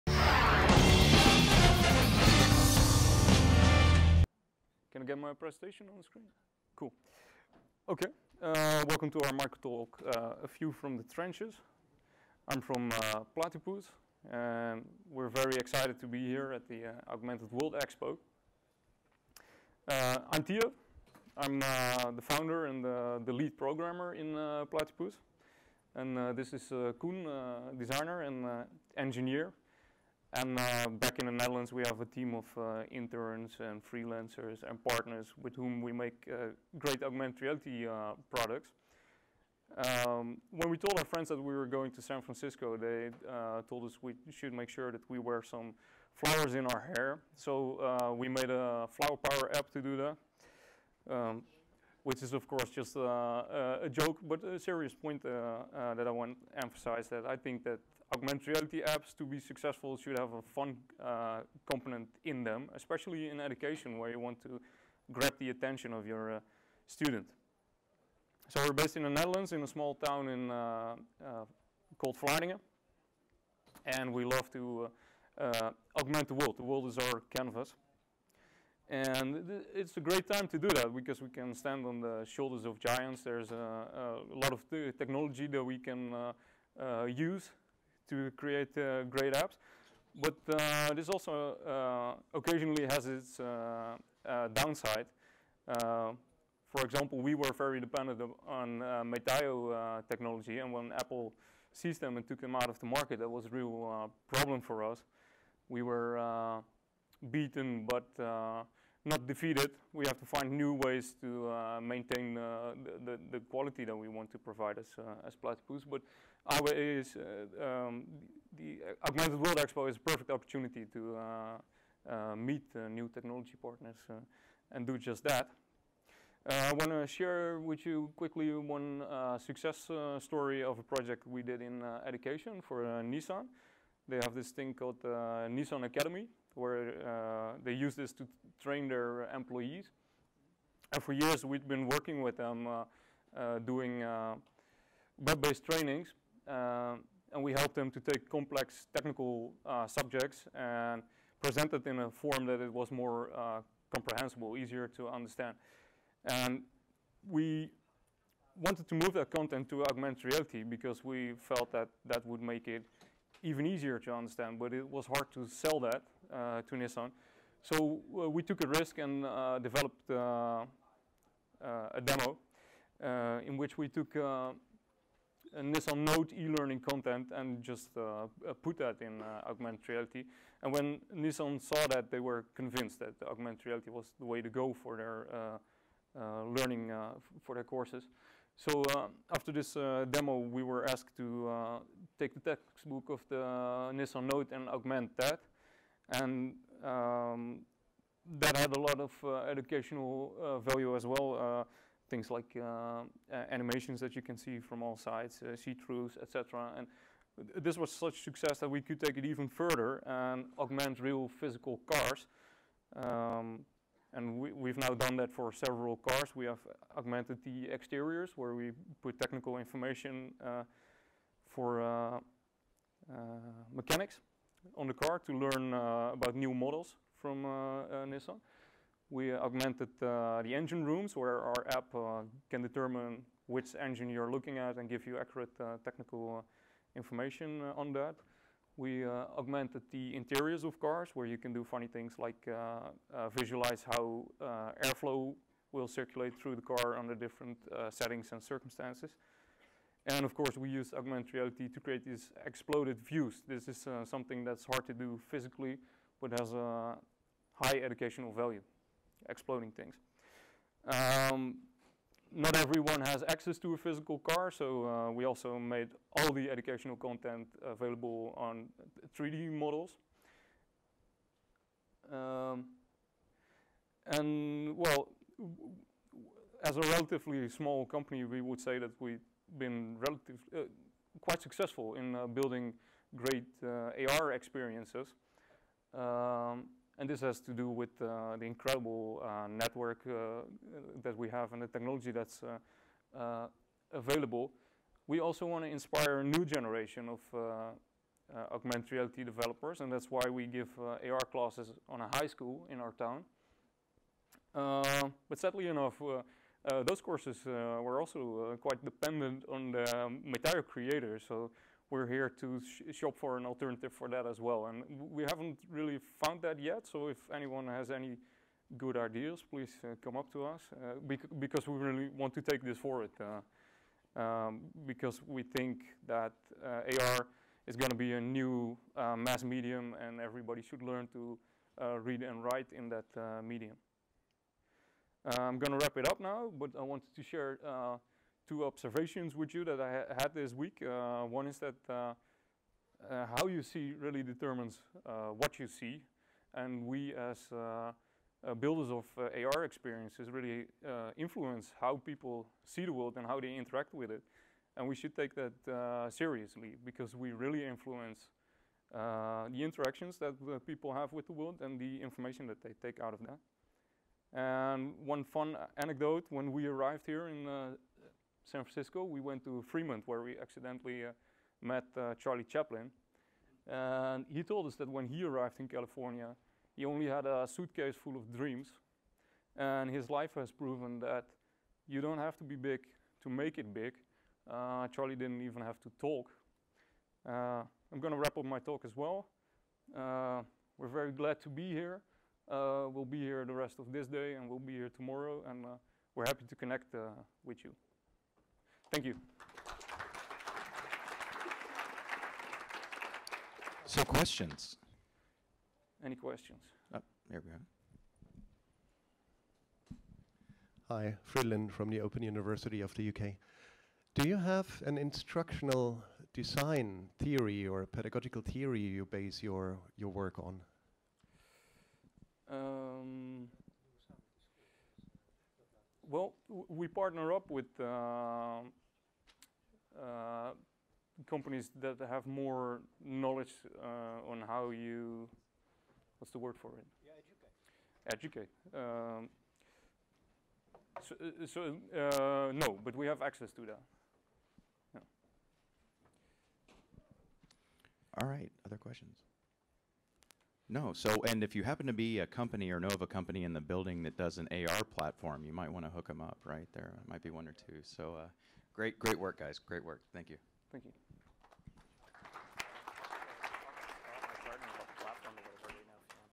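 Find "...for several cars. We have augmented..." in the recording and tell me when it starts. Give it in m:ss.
3:35.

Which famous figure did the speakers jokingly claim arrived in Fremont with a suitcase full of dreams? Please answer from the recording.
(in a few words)
Charlie Chaplin.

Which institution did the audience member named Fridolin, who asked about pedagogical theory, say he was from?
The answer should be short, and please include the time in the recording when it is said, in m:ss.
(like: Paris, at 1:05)
Open University of the UK, at 6:52.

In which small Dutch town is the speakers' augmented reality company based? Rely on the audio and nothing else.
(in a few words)
Vlaardingen.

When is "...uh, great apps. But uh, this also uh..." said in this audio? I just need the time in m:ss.
1:28.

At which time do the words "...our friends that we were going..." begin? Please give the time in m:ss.
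0:40.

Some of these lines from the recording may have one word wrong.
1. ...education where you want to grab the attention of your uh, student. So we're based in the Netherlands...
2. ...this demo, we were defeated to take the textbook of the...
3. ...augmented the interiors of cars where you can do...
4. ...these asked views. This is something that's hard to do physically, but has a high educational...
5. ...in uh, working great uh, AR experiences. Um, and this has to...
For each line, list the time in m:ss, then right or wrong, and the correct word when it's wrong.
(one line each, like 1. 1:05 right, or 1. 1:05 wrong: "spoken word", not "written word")
1. 1:03 right
2. 3:09 wrong: "asked", not "defeated"
3. 3:59 right
4. 4:12 wrong: "exploded", not "asked"
5. 4:41 wrong: "building", not "working".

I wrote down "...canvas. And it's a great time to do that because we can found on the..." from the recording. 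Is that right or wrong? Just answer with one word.
wrong.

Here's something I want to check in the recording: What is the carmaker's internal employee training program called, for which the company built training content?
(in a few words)
Nissan Academy.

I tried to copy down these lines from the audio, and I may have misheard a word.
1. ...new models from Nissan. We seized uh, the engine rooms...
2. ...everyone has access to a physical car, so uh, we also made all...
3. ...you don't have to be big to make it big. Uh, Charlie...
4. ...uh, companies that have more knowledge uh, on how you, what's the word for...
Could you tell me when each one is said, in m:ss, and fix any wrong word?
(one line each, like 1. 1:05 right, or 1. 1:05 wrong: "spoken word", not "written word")
1. 3:46 wrong: "augmented", not "seized"
2. 4:22 right
3. 6:21 right
4. 7:09 right.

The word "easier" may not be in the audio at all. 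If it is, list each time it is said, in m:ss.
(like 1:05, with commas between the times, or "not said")
2:34, 2:43.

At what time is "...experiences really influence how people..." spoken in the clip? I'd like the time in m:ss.
5:49.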